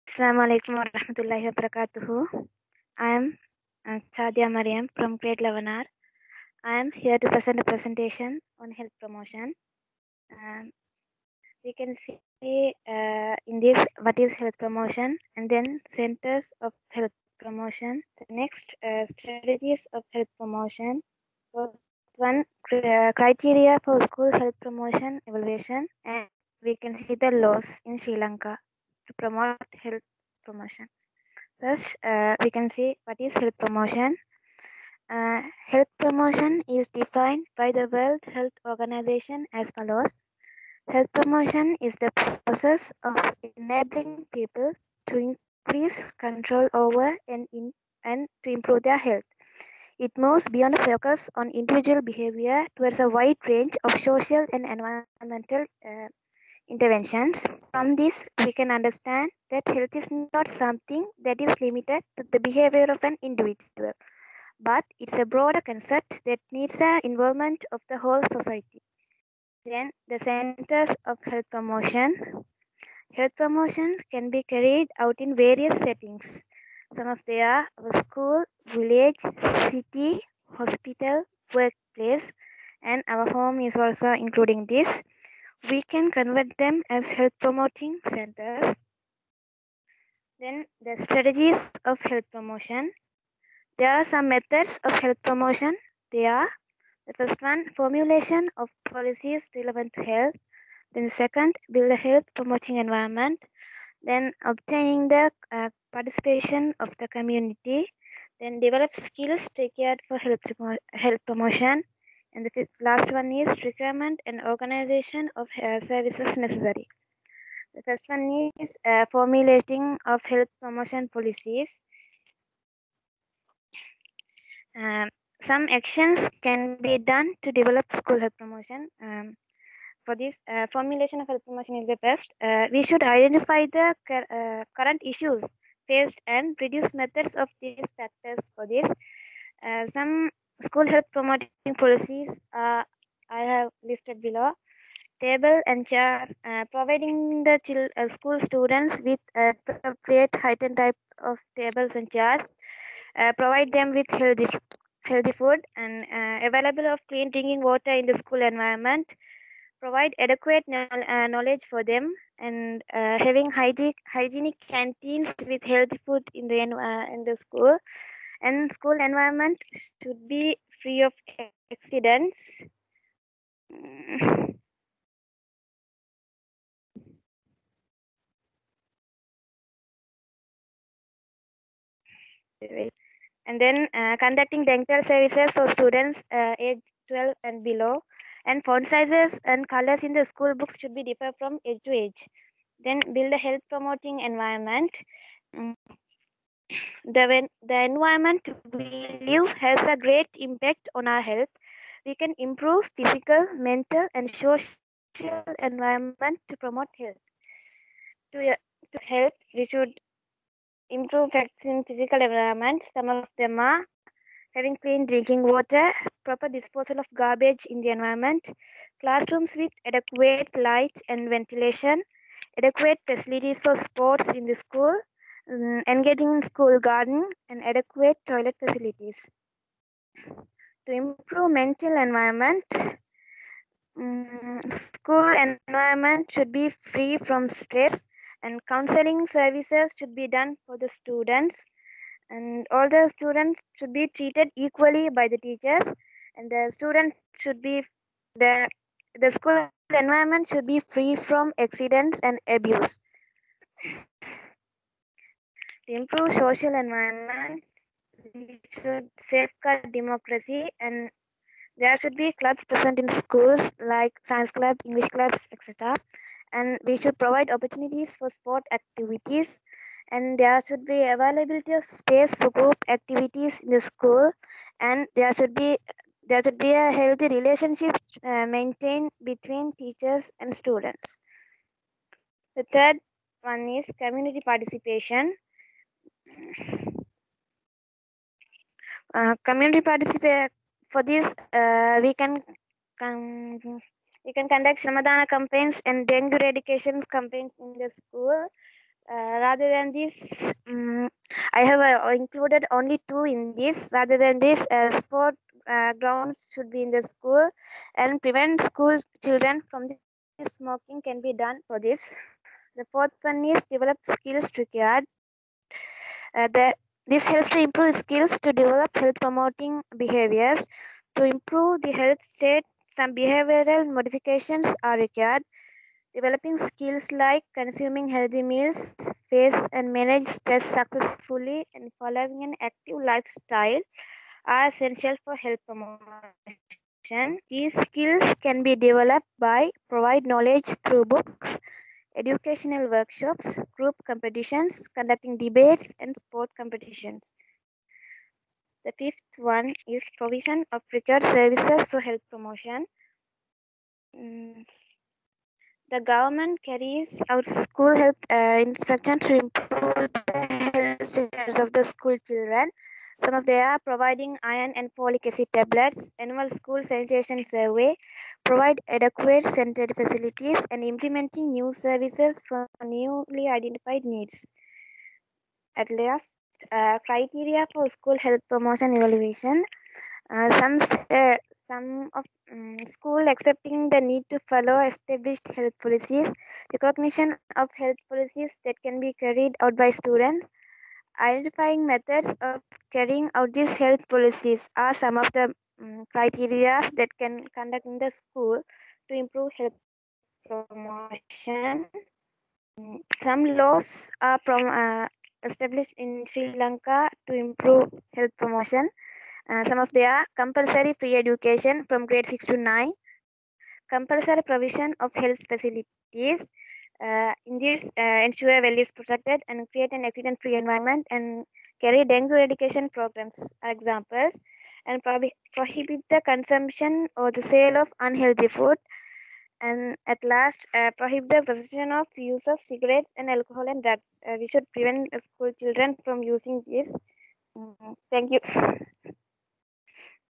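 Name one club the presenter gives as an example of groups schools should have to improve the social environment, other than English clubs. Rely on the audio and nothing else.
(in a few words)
Science club.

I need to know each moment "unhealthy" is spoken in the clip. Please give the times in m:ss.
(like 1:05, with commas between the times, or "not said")
7:07.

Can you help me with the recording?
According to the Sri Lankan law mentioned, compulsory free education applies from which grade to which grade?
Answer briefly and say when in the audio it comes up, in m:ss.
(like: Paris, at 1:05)
Grade 6 to 9, at 6:52.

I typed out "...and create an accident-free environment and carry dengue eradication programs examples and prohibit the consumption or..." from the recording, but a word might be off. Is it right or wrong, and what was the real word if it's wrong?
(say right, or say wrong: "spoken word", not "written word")
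right.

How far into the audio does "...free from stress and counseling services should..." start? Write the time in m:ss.
3:56.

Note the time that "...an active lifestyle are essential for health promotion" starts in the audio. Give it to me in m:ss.
5:32.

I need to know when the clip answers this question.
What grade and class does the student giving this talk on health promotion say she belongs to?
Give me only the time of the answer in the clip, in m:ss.
0:05.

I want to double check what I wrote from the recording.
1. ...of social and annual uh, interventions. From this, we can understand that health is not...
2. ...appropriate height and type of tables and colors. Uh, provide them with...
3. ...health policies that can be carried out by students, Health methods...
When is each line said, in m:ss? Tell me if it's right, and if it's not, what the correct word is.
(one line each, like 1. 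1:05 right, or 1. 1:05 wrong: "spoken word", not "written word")
1. 0:53 wrong: "environmental", not "annual"
2. 2:29 wrong: "chairs", not "colors"
3. 6:27 wrong: "Identifying", not "Health".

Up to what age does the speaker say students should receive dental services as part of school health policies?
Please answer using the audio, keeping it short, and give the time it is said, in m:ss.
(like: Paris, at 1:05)
12, at 3:06.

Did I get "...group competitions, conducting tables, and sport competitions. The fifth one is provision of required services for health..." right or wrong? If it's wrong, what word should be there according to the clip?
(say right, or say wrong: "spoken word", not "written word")
wrong: "debates", not "tables".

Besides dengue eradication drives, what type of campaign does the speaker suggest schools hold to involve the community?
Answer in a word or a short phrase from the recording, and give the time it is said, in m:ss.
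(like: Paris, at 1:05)
Shramadana campaigns, at 4:54.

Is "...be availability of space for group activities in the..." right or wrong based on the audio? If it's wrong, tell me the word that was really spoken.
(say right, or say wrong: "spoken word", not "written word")
right.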